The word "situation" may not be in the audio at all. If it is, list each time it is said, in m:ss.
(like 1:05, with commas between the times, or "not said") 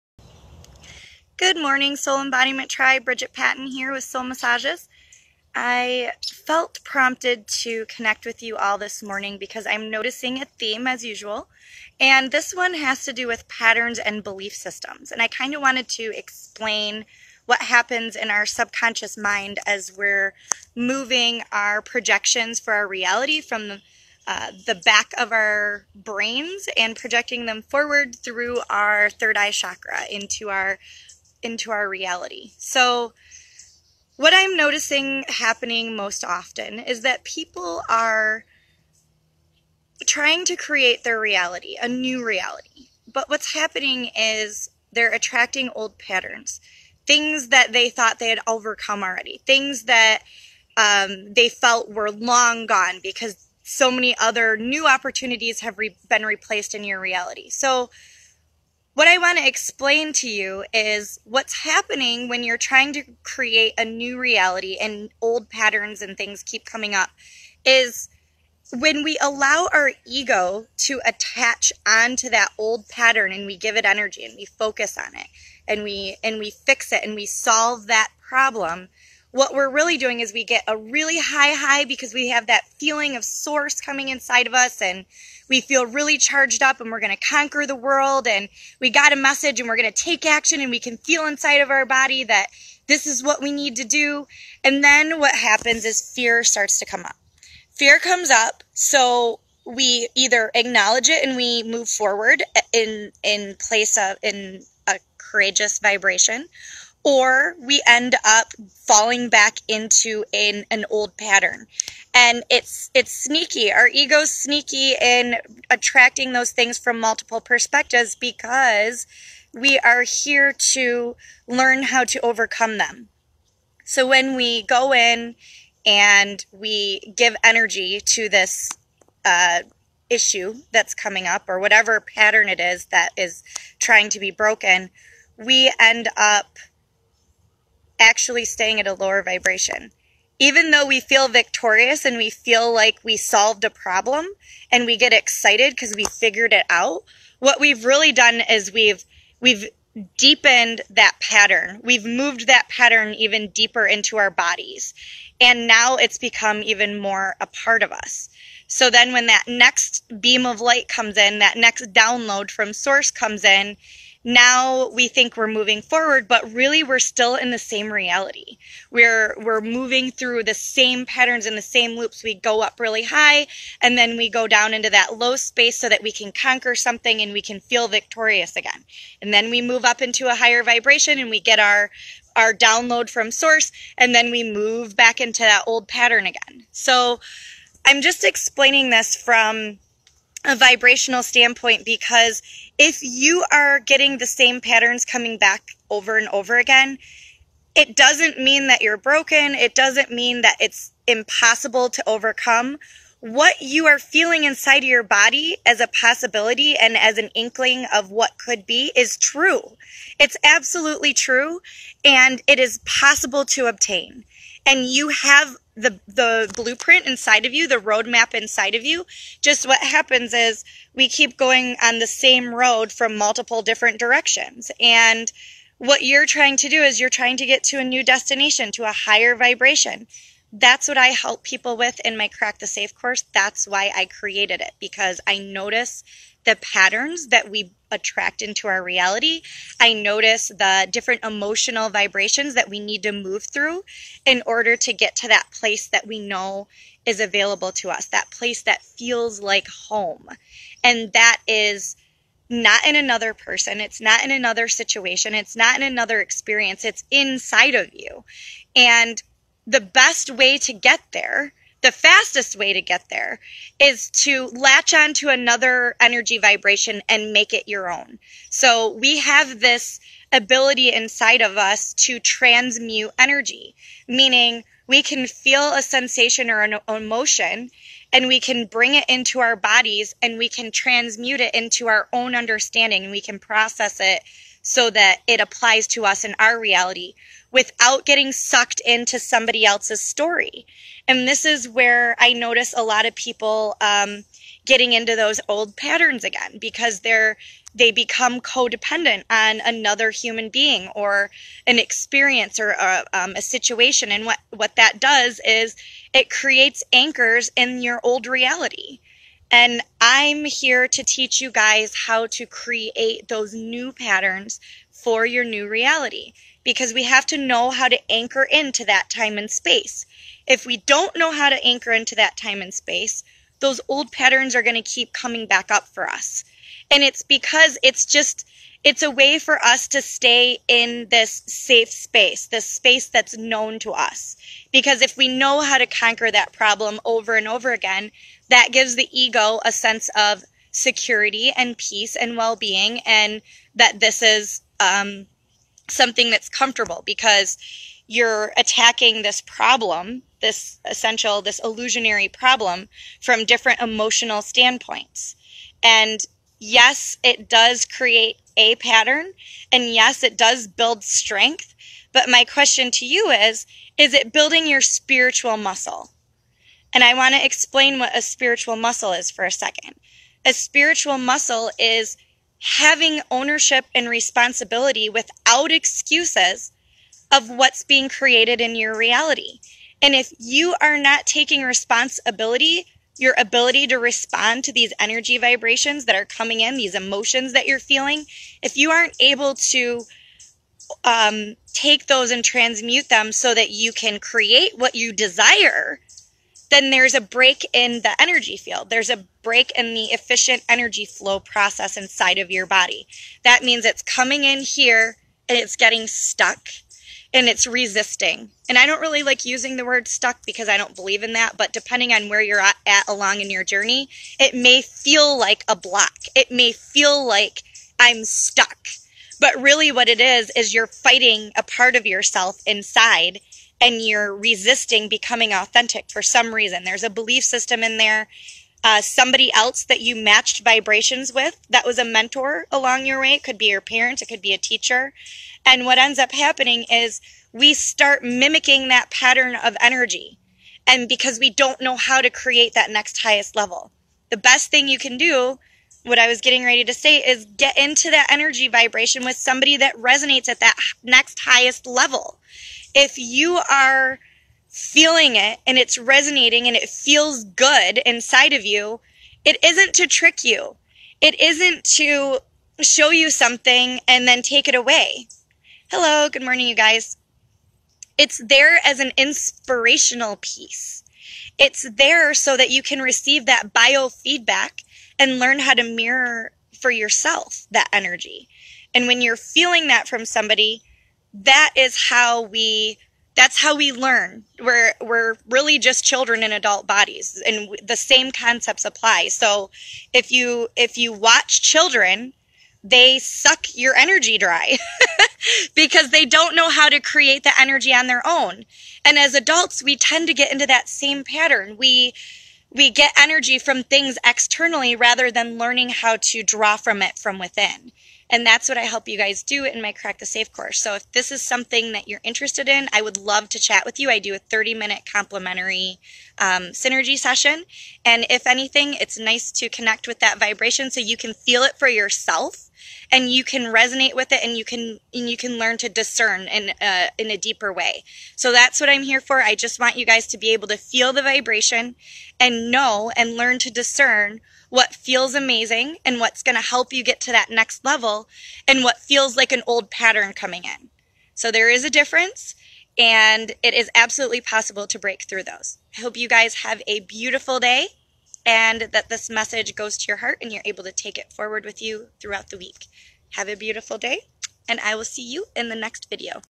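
4:14, 5:03.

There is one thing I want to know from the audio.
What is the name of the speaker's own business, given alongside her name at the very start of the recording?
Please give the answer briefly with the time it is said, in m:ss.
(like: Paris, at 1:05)
Soul Massages, at 0:04.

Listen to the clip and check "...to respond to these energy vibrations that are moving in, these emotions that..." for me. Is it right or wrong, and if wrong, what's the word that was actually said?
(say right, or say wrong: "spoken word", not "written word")
wrong: "coming", not "moving".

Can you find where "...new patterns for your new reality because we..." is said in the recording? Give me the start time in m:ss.
5:13.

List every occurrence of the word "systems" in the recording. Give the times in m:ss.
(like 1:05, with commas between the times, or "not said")
0:14, 7:07.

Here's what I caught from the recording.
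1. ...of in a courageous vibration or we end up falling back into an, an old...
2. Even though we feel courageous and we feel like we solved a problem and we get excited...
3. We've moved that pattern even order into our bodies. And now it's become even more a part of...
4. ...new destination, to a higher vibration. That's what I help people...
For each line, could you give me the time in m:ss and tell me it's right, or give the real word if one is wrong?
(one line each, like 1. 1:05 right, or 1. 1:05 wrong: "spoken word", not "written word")
1. 1:43 right
2. 2:20 wrong: "victorious", not "courageous"
3. 2:31 wrong: "deeper", not "order"
4. 3:47 right.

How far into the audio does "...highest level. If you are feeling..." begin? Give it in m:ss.
7:31.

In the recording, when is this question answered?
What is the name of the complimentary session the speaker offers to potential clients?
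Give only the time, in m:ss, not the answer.
8:36.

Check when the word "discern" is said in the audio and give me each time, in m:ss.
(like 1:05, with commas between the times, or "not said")
8:45, 8:53.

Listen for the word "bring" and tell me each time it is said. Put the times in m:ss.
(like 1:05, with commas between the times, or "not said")
4:38.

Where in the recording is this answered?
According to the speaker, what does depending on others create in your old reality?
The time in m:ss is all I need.
5:06.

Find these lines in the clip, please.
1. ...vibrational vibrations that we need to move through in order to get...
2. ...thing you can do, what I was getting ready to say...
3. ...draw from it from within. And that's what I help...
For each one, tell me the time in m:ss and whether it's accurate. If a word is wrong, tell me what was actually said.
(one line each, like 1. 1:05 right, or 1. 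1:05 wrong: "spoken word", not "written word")
1. 4:01 wrong: "emotional", not "vibrational"
2. 7:24 right
3. 8:26 right.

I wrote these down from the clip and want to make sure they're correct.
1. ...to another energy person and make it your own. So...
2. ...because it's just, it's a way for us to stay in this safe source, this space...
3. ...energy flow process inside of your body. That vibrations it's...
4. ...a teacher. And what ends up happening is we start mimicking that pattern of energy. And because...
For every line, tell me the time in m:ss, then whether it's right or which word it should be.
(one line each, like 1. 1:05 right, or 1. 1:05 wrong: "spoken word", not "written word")
1. 4:25 wrong: "vibration", not "person"
2. 5:27 wrong: "space", not "source"
3. 6:40 wrong: "means", not "vibrations"
4. 7:14 right.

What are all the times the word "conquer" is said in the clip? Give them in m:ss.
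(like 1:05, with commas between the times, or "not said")
1:27, 2:56, 5:35.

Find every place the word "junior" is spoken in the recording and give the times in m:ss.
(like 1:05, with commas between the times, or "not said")
not said.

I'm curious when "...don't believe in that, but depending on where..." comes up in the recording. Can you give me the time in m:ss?
6:50.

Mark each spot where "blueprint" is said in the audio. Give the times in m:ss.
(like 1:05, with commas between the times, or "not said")
3:36.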